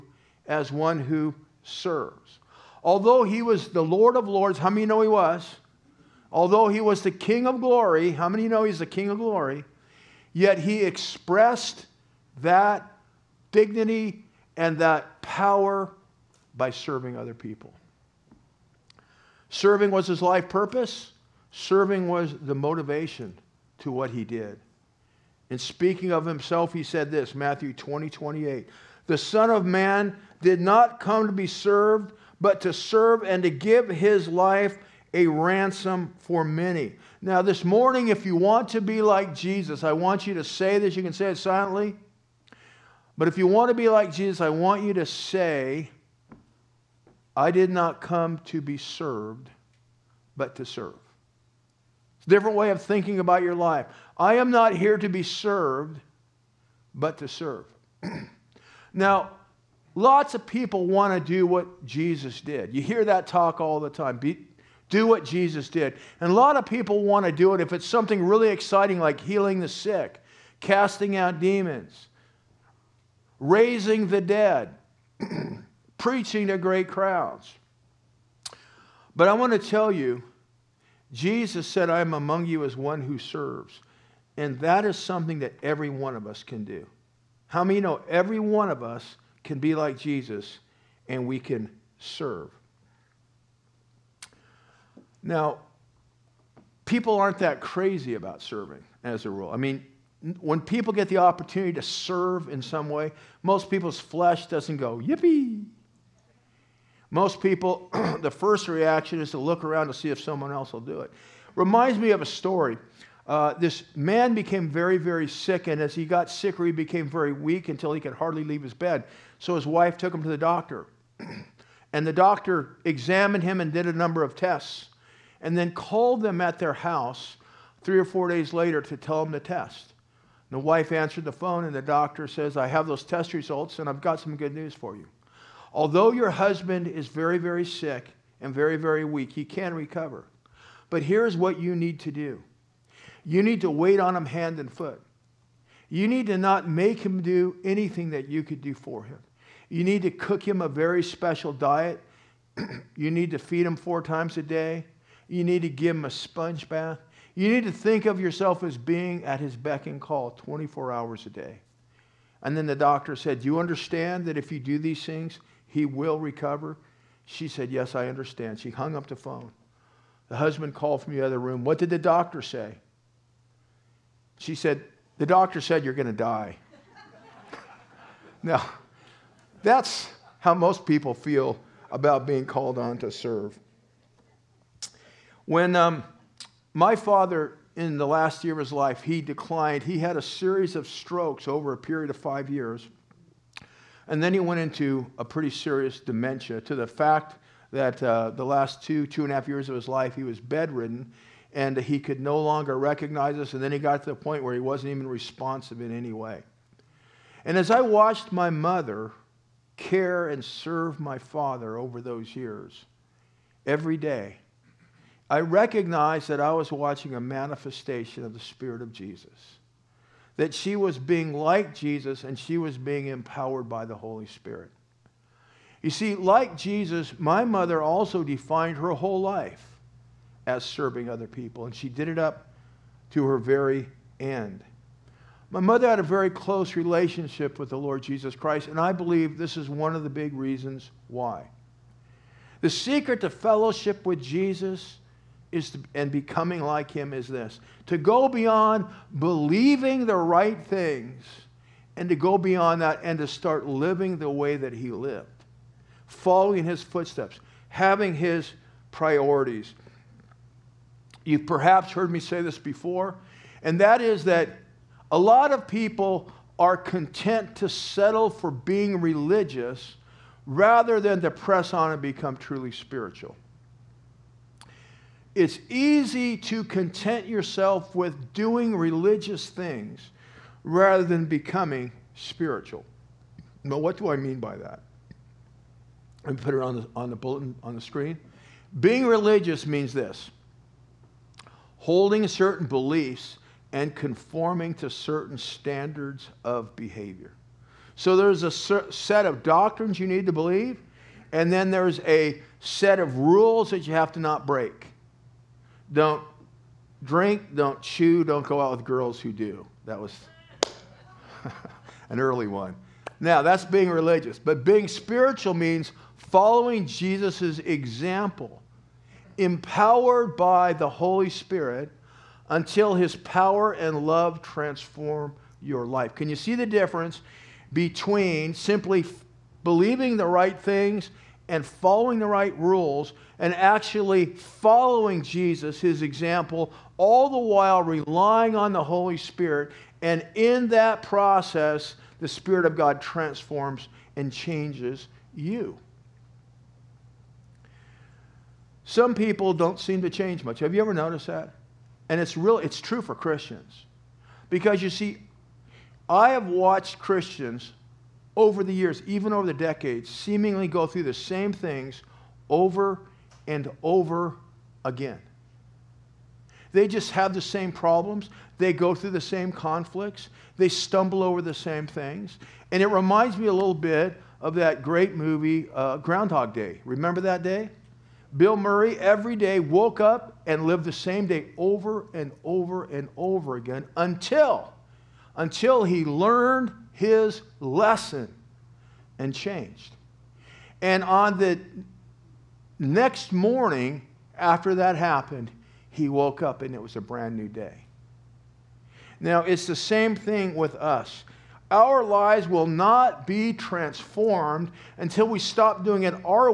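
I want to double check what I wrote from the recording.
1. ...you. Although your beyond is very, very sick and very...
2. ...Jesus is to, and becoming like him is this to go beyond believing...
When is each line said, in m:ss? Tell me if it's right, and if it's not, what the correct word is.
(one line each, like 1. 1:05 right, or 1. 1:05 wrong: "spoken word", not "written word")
1. 2:14 wrong: "husband", not "beyond"
2. 4:04 right.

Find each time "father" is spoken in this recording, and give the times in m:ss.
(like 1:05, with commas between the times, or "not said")
3:06, 3:31.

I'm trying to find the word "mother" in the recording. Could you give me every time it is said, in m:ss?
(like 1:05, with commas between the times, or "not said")
3:28, 3:47, 3:55.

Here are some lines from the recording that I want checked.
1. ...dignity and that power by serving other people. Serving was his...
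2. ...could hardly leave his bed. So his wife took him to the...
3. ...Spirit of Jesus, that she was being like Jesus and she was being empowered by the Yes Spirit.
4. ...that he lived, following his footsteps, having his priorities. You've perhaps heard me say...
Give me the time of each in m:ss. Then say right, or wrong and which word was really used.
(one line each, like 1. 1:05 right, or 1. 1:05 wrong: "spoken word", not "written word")
1. 0:13 right
2. 1:57 right
3. 3:38 wrong: "Holy", not "Yes"
4. 4:14 right.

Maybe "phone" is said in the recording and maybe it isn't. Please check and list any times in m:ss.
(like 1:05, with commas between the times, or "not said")
2:11, 2:49.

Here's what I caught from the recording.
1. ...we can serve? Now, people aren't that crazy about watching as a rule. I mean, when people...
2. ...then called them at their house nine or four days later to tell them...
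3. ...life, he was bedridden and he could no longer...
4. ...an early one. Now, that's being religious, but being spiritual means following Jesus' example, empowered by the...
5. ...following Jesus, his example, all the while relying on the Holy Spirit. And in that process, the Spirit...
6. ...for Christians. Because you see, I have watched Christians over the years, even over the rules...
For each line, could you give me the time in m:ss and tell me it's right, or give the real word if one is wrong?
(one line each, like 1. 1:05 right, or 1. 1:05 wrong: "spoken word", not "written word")
1. 1:31 wrong: "serving", not "watching"
2. 2:05 wrong: "three", not "nine"
3. 3:19 right
4. 5:12 right
5. 5:34 right
6. 5:53 wrong: "decades", not "rules".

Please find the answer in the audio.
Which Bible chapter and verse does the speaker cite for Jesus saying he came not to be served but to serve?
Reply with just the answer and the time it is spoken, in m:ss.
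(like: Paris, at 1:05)
Matthew 20:28, at 0:27.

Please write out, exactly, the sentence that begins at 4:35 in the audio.
It's easy to content yourself with doing religious things rather than becoming spiritual.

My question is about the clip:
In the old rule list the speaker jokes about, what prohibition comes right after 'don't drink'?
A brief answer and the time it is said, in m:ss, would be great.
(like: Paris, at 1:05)
don't chew, at 5:07.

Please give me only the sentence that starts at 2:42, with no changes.
And then the doctor said, Do you understand that if you do these things, he will recover?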